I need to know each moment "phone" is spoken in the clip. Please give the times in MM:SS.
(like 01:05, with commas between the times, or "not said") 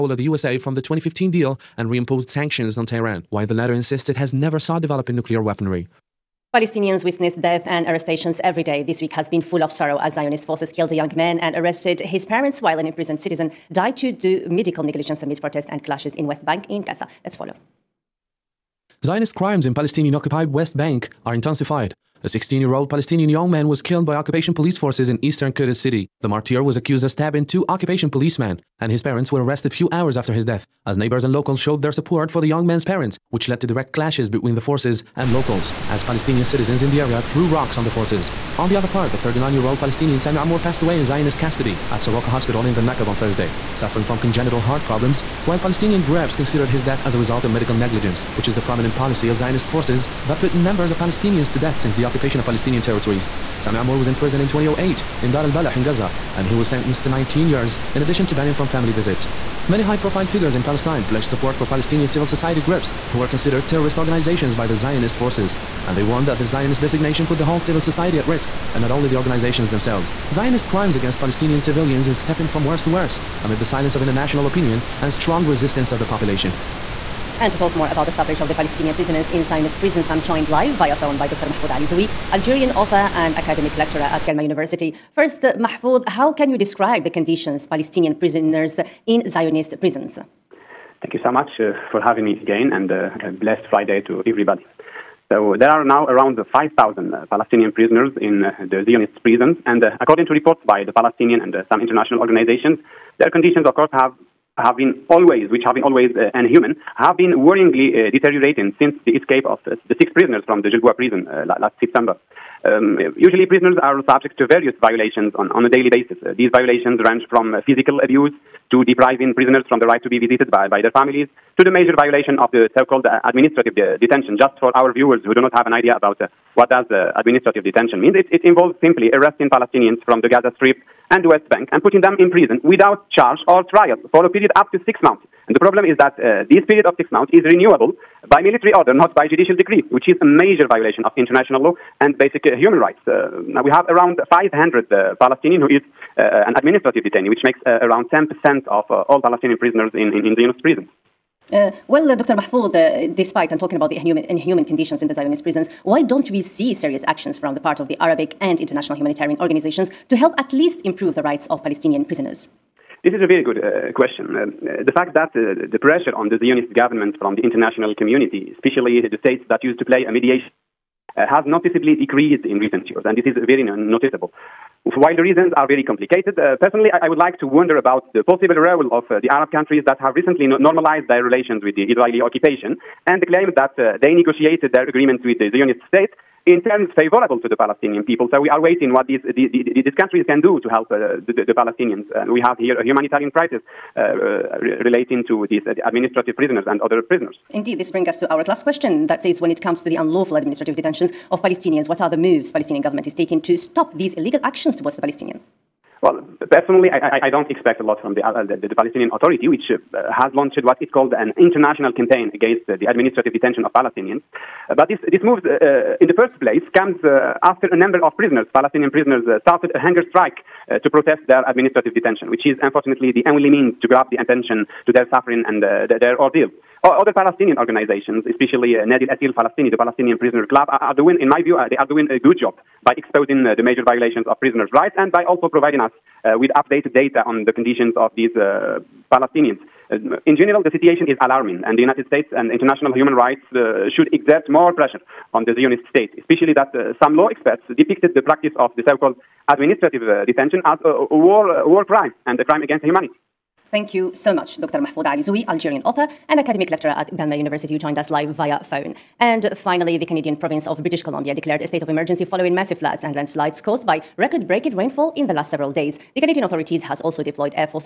01:20, 04:18.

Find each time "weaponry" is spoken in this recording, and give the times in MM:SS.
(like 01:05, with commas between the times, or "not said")
00:05.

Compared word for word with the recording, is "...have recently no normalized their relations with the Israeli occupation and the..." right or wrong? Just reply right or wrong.
right.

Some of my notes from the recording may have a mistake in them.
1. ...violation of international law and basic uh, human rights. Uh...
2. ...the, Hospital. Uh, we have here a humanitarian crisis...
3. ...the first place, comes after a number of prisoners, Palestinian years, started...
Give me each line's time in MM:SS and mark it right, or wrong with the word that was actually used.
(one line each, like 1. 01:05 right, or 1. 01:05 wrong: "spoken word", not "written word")
1. 02:20 right
2. 03:11 wrong: "Palestinians", not "Hospital"
3. 03:36 wrong: "prisoners", not "years".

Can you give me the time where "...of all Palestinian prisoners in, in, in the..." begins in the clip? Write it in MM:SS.
02:28.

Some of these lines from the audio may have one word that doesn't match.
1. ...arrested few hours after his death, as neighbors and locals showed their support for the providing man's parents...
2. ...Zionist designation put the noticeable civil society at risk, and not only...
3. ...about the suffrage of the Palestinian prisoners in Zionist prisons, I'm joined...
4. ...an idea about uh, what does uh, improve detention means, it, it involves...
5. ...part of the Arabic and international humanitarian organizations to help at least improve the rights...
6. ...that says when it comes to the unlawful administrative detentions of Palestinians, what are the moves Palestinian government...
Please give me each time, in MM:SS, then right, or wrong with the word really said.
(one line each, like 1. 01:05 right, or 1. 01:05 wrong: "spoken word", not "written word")
1. 00:29 wrong: "young", not "providing"
2. 01:06 wrong: "whole", not "noticeable"
3. 01:17 right
4. 02:05 wrong: "administrative", not "improve"
5. 02:37 right
6. 03:19 right.